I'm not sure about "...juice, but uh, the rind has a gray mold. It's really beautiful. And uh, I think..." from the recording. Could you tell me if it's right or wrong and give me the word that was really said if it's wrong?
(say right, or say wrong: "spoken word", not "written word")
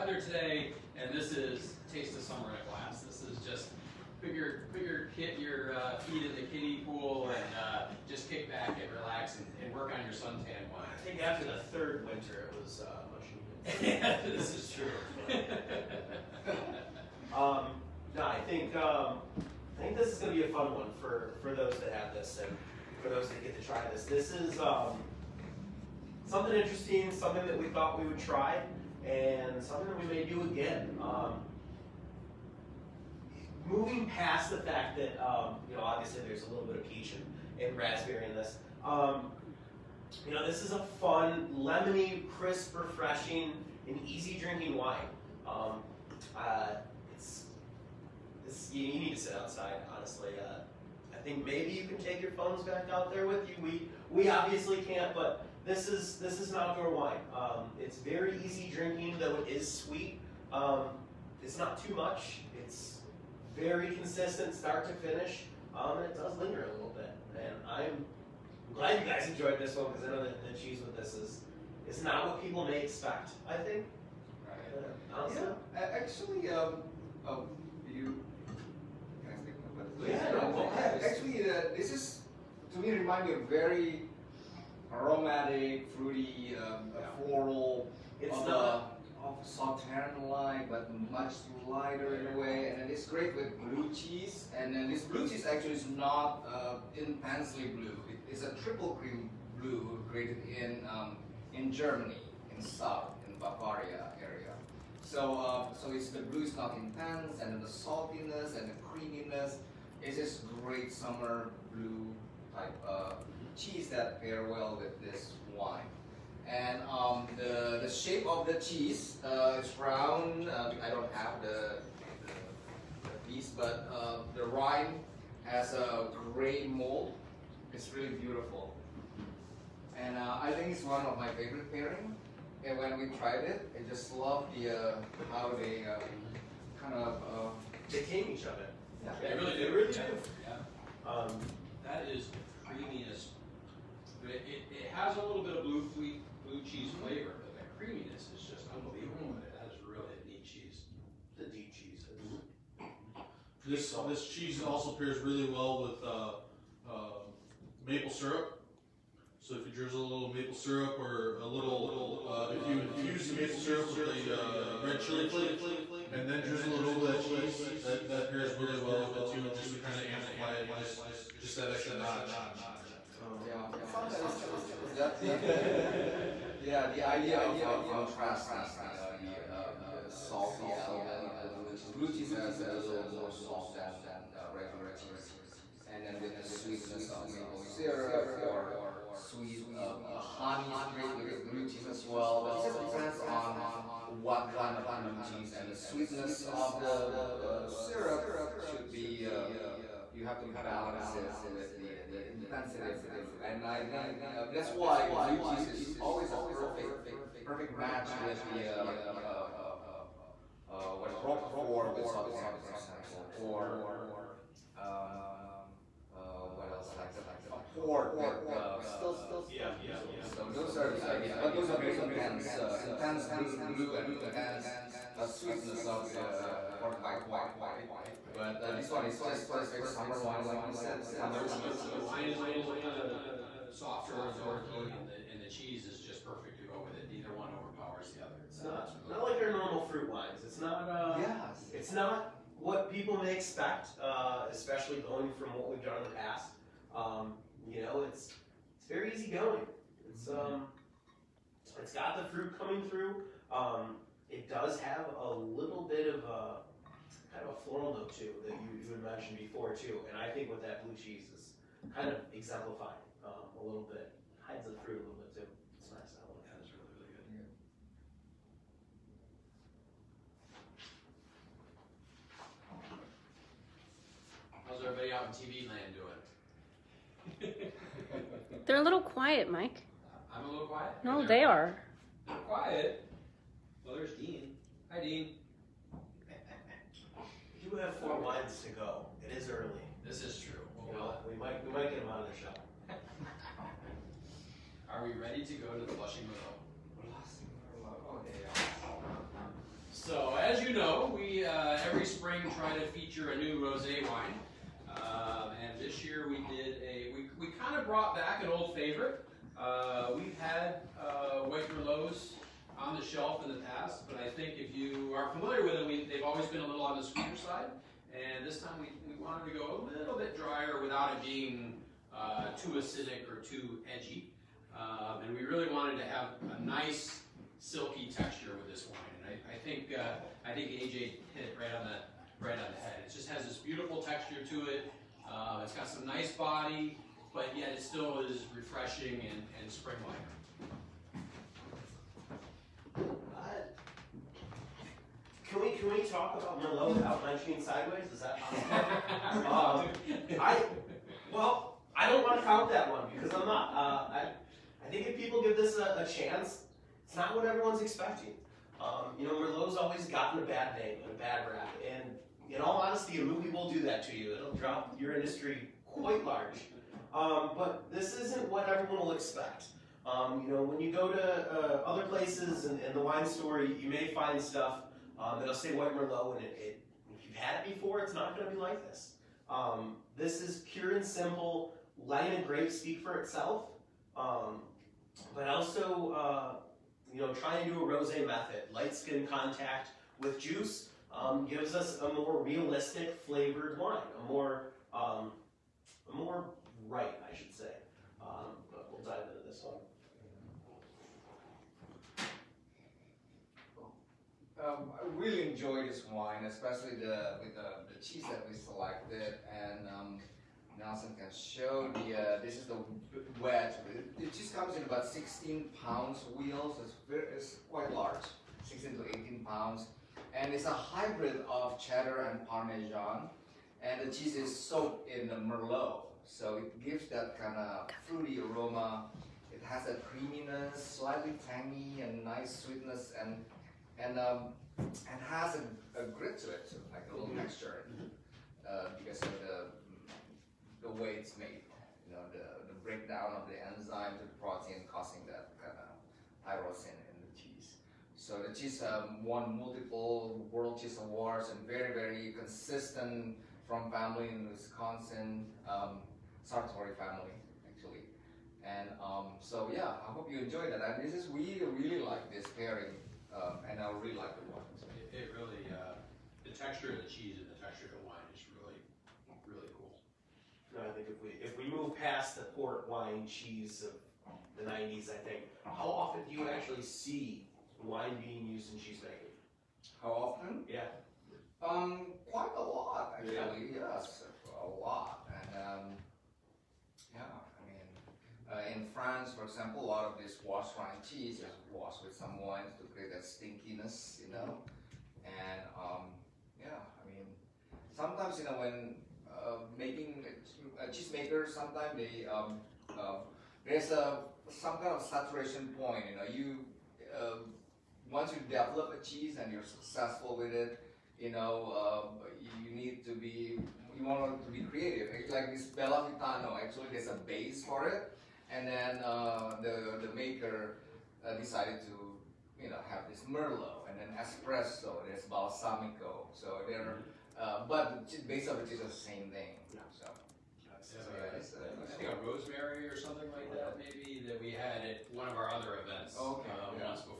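wrong: "piece", not "juice".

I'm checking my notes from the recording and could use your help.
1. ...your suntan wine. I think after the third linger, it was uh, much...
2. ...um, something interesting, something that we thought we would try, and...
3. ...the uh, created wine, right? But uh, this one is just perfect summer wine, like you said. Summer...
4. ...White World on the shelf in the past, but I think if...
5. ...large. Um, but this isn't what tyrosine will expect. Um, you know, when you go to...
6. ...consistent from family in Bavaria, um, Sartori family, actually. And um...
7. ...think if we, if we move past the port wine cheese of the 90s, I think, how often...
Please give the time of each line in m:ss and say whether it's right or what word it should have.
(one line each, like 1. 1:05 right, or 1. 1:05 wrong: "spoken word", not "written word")
1. 0:10 wrong: "winter", not "linger"
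2. 0:24 right
3. 3:46 wrong: "fortified", not "created"
4. 5:11 wrong: "Merlots", not "World"
5. 6:06 wrong: "everyone", not "tyrosine"
6. 7:32 wrong: "Wisconsin", not "Bavaria"
7. 7:50 right.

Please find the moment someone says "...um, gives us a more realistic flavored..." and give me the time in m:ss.
6:31.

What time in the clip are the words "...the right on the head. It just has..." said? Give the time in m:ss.
5:31.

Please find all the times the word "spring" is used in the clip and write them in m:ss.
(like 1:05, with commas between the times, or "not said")
5:02, 5:39.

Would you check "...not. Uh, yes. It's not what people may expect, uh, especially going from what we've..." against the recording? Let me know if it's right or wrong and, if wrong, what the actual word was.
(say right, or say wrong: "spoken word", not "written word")
right.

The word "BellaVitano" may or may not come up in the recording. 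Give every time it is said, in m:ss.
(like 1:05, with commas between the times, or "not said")
8:35.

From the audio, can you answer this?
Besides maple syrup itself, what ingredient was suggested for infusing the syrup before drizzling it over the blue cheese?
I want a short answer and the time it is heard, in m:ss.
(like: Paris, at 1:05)
Red chili flake, at 2:44.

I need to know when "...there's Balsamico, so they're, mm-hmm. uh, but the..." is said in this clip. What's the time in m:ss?
8:45.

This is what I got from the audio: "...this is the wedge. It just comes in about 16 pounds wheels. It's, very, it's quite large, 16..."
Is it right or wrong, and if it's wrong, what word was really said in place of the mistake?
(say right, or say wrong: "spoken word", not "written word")
right.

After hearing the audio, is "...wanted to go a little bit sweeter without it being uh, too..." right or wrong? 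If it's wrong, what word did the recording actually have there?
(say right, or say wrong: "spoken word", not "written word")
wrong: "drier", not "sweeter".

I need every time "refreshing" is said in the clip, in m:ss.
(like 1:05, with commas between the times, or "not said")
0:42, 5:38.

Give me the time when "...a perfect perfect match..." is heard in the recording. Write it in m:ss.
3:26.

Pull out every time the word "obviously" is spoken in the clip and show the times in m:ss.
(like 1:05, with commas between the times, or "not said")
0:35, 0:54.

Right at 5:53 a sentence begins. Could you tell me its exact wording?
Uh, I I think if people give this a, a chance, it's not what everyone's expecting.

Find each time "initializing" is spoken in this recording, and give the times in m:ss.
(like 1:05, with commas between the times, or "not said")
not said.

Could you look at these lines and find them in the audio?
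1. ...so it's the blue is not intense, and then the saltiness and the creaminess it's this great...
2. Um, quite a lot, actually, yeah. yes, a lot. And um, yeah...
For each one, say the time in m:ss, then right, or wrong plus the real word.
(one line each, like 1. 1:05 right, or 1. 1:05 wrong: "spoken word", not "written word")
1. 1:45 right
2. 8:01 right.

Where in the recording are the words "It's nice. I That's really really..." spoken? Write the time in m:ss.
4:25.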